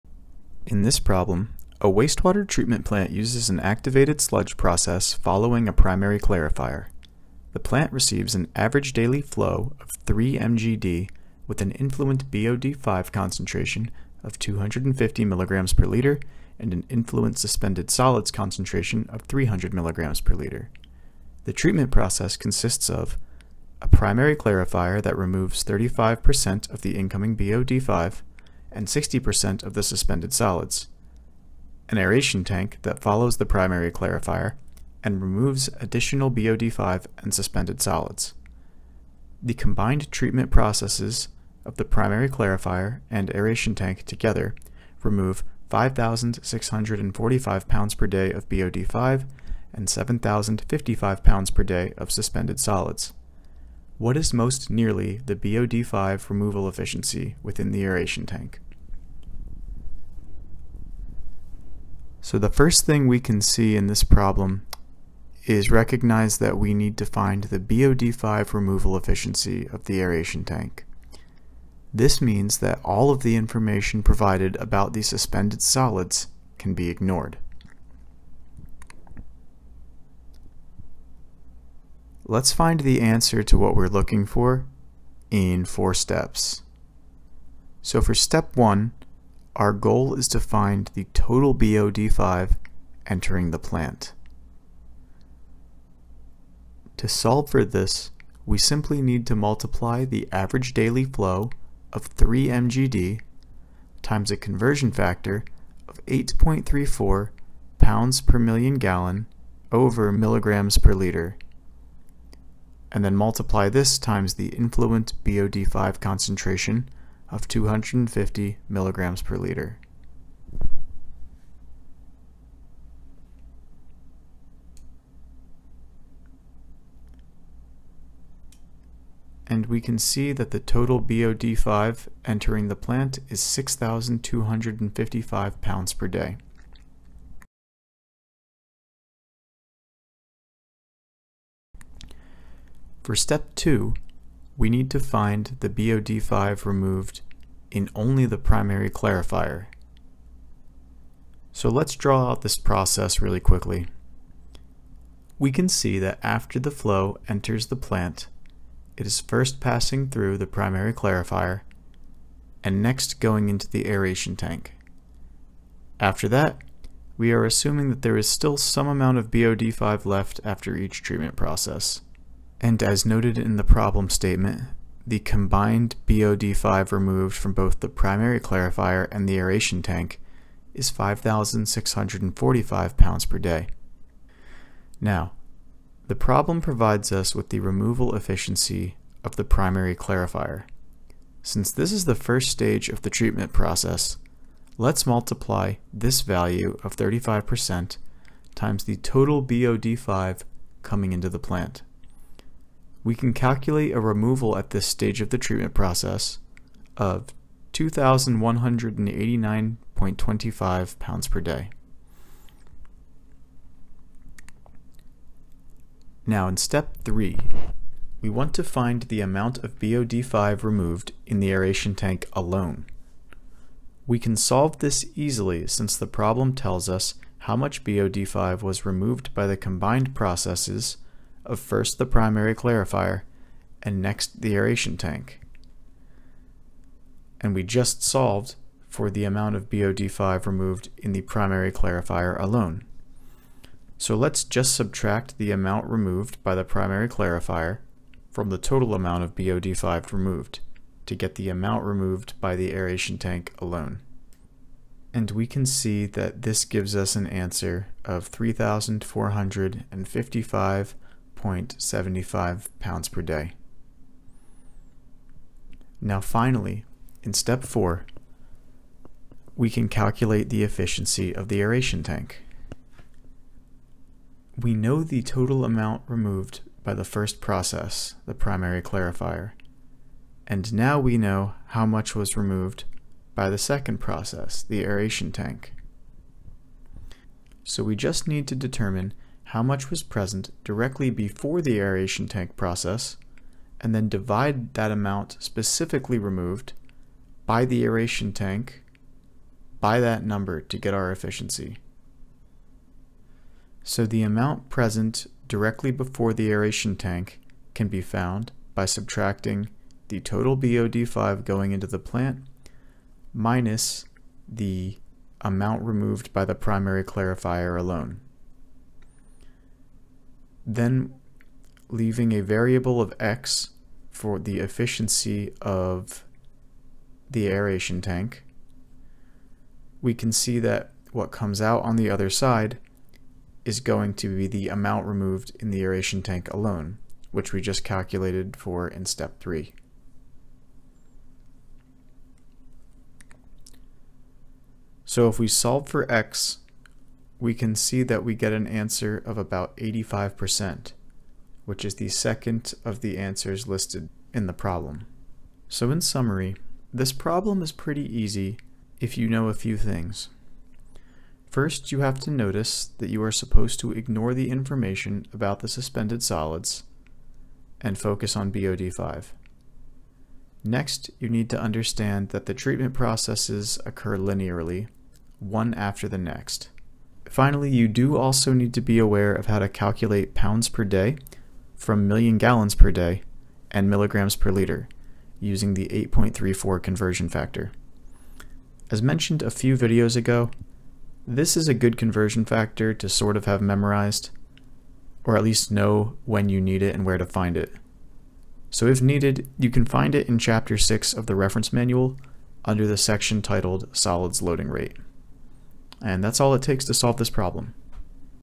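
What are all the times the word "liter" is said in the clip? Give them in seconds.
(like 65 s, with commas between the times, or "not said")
15 s, 20 s, 110 s, 119 s, 384 s.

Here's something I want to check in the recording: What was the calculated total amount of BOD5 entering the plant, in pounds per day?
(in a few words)
6,255.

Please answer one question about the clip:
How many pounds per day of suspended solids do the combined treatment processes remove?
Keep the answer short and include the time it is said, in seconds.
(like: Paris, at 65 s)
7,055, at 49 s.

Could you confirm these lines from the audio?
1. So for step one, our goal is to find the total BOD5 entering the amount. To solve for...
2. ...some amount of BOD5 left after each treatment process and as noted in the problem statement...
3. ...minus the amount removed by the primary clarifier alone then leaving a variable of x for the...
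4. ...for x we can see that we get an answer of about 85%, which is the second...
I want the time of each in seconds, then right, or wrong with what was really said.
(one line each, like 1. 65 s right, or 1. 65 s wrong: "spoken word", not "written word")
1. 87 s wrong: "plant", not "amount"
2. 168 s right
3. 313 s right
4. 345 s right.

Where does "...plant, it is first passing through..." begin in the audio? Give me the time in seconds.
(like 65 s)
157 s.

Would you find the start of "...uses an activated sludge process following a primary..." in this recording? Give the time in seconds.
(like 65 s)
3 s.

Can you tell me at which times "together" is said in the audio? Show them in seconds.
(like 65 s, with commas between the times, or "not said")
44 s.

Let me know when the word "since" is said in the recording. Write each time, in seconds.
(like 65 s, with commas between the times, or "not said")
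191 s, 225 s.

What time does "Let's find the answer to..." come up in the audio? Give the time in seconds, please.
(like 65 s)
82 s.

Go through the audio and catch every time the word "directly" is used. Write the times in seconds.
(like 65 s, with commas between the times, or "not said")
290 s, 305 s.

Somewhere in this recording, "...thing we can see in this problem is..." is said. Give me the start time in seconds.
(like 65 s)
62 s.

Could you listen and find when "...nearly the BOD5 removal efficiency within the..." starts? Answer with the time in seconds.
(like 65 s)
54 s.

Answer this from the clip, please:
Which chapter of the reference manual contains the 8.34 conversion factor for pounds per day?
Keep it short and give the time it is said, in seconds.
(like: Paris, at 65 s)
Chapter 6, at 400 s.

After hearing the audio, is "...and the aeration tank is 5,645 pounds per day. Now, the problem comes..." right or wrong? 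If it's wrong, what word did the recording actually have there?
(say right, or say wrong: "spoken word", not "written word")
wrong: "provides", not "comes".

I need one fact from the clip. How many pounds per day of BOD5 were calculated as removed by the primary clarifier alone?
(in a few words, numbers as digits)
2,189.25.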